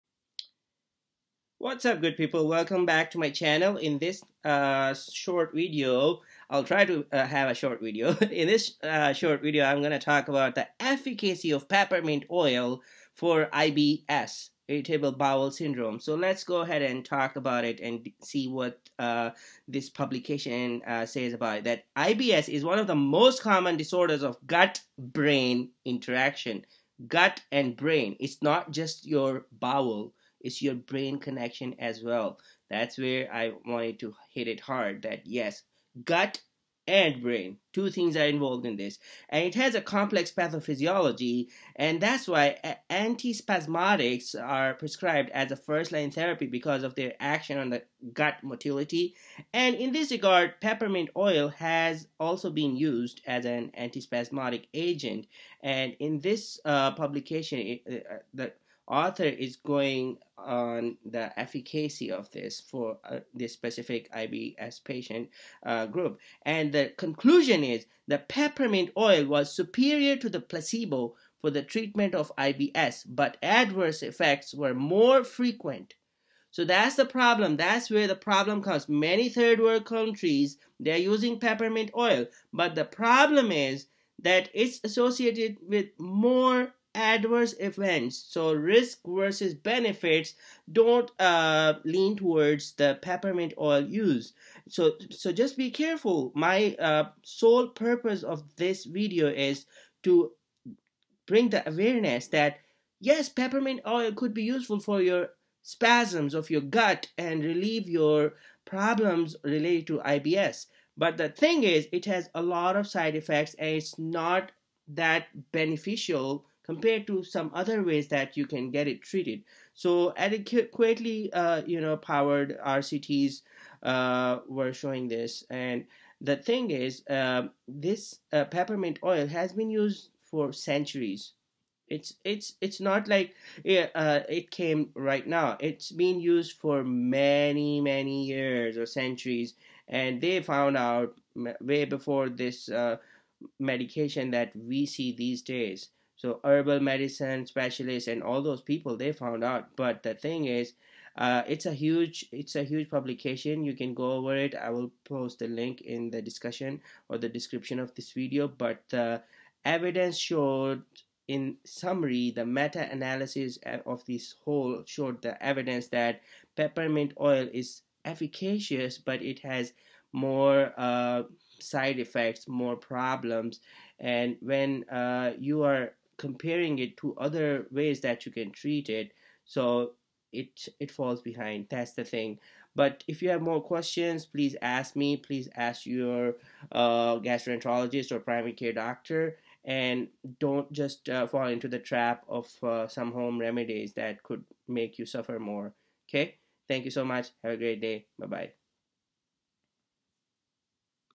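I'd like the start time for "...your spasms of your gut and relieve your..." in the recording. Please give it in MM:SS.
01:45.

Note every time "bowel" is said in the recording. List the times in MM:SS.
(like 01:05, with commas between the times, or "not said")
00:15, 00:29.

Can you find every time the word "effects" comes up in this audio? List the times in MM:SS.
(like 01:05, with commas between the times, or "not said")
01:14, 01:53, 02:51.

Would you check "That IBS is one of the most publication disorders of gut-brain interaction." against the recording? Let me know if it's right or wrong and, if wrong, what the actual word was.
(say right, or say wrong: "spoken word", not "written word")
wrong: "common", not "publication".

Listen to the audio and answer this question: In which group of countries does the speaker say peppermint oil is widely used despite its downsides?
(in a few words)
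Third world countries.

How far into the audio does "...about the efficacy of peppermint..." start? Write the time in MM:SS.
00:10.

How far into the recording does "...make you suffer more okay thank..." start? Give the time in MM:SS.
03:14.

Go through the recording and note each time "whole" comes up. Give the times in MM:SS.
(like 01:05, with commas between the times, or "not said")
02:44.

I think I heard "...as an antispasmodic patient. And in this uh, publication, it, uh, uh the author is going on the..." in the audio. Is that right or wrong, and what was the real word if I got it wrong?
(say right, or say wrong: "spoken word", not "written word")
wrong: "agent", not "patient".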